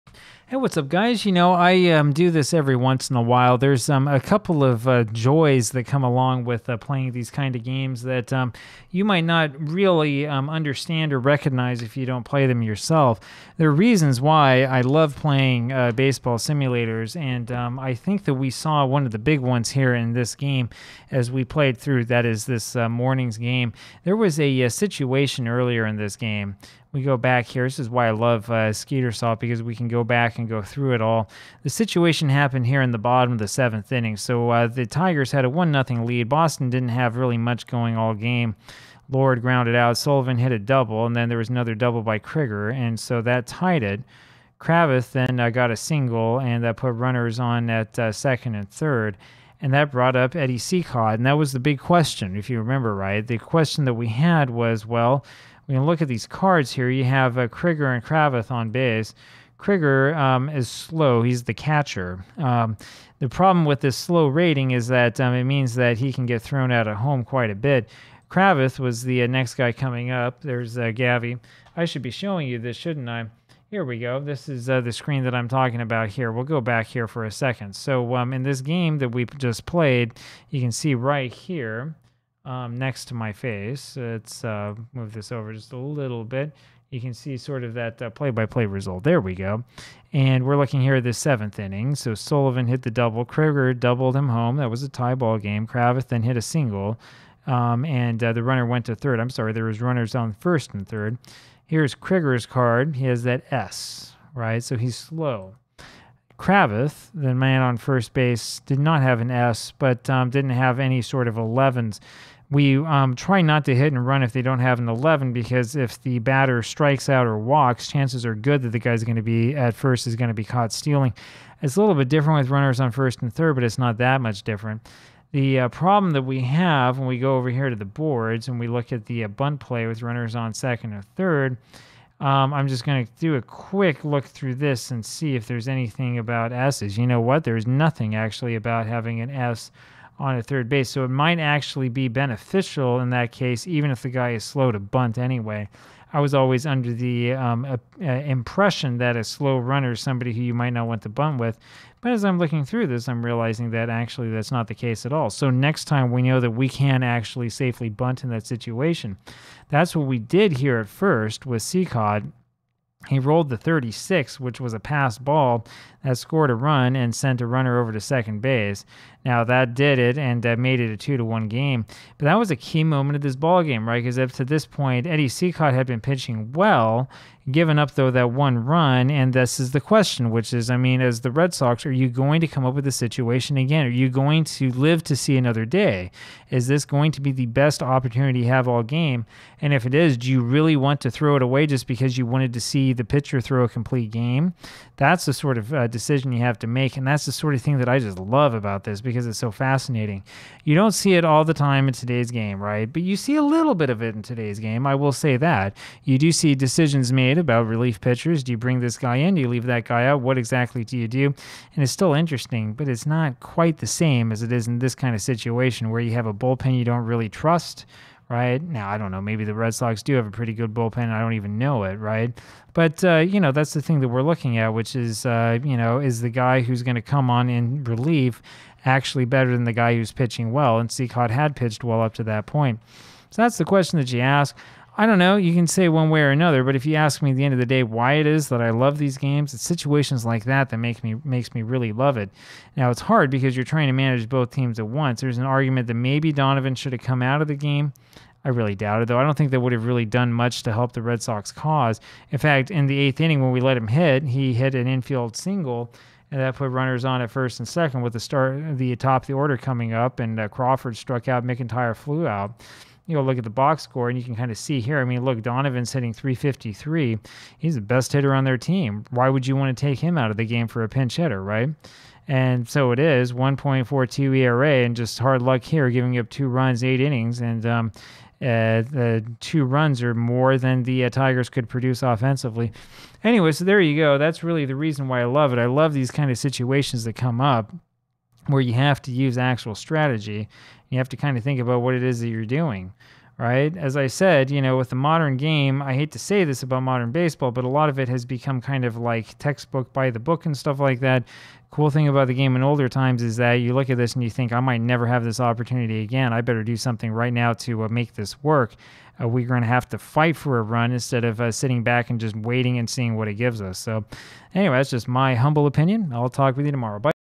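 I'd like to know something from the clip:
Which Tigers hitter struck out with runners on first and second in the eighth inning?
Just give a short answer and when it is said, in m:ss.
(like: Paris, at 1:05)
Crawford, at 4:20.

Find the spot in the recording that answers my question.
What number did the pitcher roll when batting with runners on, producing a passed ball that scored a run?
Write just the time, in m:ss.
2:43.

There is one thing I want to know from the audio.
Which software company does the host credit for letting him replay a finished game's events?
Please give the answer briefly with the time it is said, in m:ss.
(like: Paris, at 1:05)
Skeetersoft, at 0:28.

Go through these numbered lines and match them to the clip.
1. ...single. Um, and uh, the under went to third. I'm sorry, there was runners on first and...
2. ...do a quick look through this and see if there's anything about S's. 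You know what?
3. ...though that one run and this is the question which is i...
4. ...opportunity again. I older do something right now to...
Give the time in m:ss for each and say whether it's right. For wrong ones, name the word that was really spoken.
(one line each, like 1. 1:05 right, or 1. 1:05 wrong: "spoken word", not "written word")
1. 1:36 wrong: "runner", not "under"
2. 2:13 right
3. 2:57 right
4. 5:05 wrong: "better", not "older".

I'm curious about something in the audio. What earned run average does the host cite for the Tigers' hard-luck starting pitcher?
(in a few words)
1.42.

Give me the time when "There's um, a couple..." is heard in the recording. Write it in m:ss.
0:03.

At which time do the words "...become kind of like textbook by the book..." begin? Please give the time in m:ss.
4:58.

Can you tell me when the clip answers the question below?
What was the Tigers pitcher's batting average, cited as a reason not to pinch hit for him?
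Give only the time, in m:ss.
4:26.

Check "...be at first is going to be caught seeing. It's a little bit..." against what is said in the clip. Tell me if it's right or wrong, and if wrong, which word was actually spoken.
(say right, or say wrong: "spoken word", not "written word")
wrong: "stealing", not "seeing".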